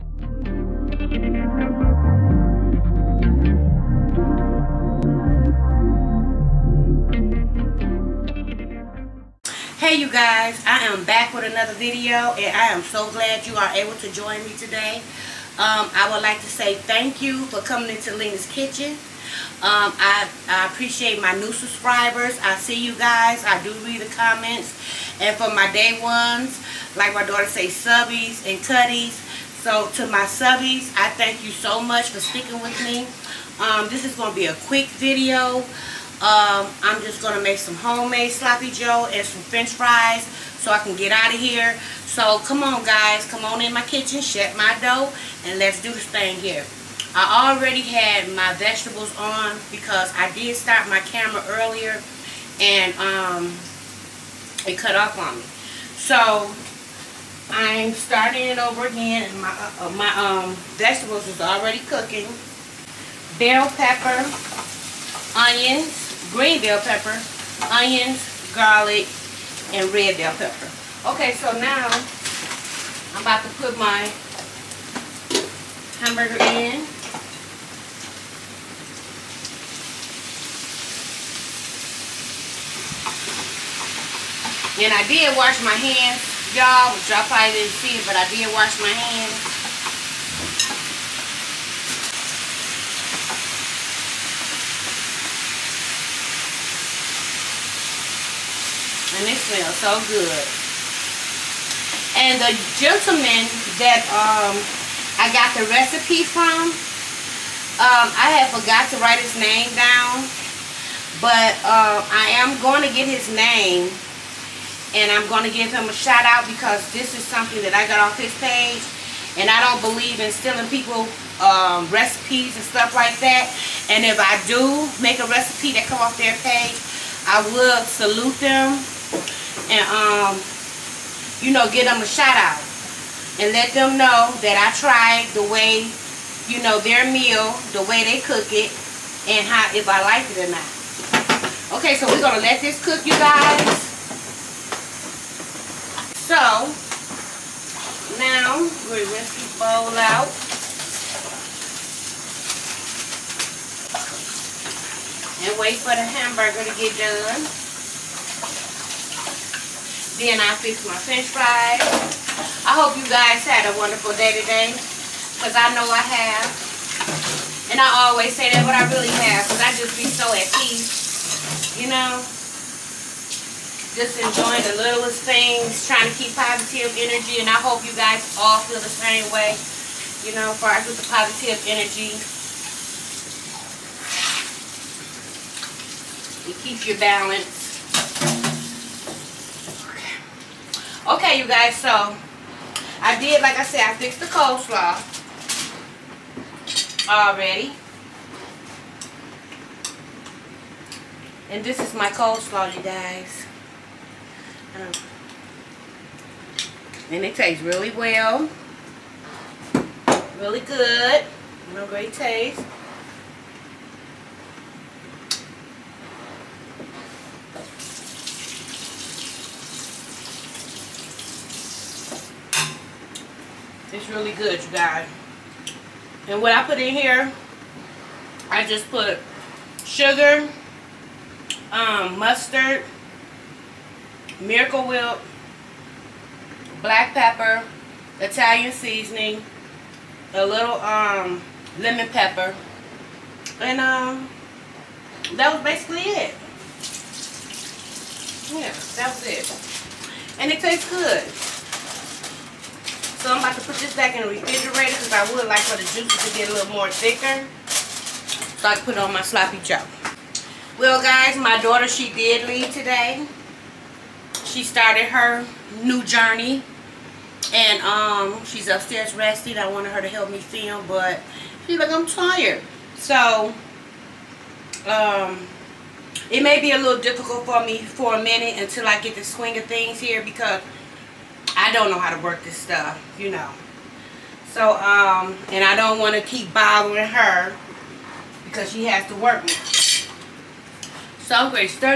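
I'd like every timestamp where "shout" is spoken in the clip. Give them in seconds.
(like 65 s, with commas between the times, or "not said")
115 s, 132 s.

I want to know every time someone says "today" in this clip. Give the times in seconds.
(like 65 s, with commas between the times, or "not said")
14 s, 164 s, 262 s.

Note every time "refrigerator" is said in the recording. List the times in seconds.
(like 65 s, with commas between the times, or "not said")
254 s.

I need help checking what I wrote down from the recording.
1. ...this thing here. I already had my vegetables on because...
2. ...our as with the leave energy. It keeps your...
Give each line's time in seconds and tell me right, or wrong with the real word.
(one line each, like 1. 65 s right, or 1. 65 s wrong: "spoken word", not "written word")
1. 45 s right
2. 180 s wrong: "positive", not "leave".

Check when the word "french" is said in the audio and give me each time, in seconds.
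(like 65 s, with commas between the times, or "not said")
39 s, 160 s.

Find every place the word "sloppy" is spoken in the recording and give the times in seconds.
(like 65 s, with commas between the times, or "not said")
38 s, 259 s.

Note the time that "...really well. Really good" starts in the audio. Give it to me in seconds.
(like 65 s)
207 s.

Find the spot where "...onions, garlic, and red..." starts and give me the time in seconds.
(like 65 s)
67 s.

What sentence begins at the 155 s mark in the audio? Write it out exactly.
And wait for the hamburger to get done.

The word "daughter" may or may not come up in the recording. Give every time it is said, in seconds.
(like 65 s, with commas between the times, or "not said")
27 s, 261 s.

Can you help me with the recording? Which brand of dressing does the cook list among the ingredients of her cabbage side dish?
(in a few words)
Miracle Whip.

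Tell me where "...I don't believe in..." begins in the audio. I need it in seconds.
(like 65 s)
119 s.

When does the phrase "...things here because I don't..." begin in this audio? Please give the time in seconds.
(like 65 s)
279 s.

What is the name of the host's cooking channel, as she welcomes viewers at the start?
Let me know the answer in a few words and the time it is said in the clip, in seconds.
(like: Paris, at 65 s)
Lena's Kitchen, at 18 s.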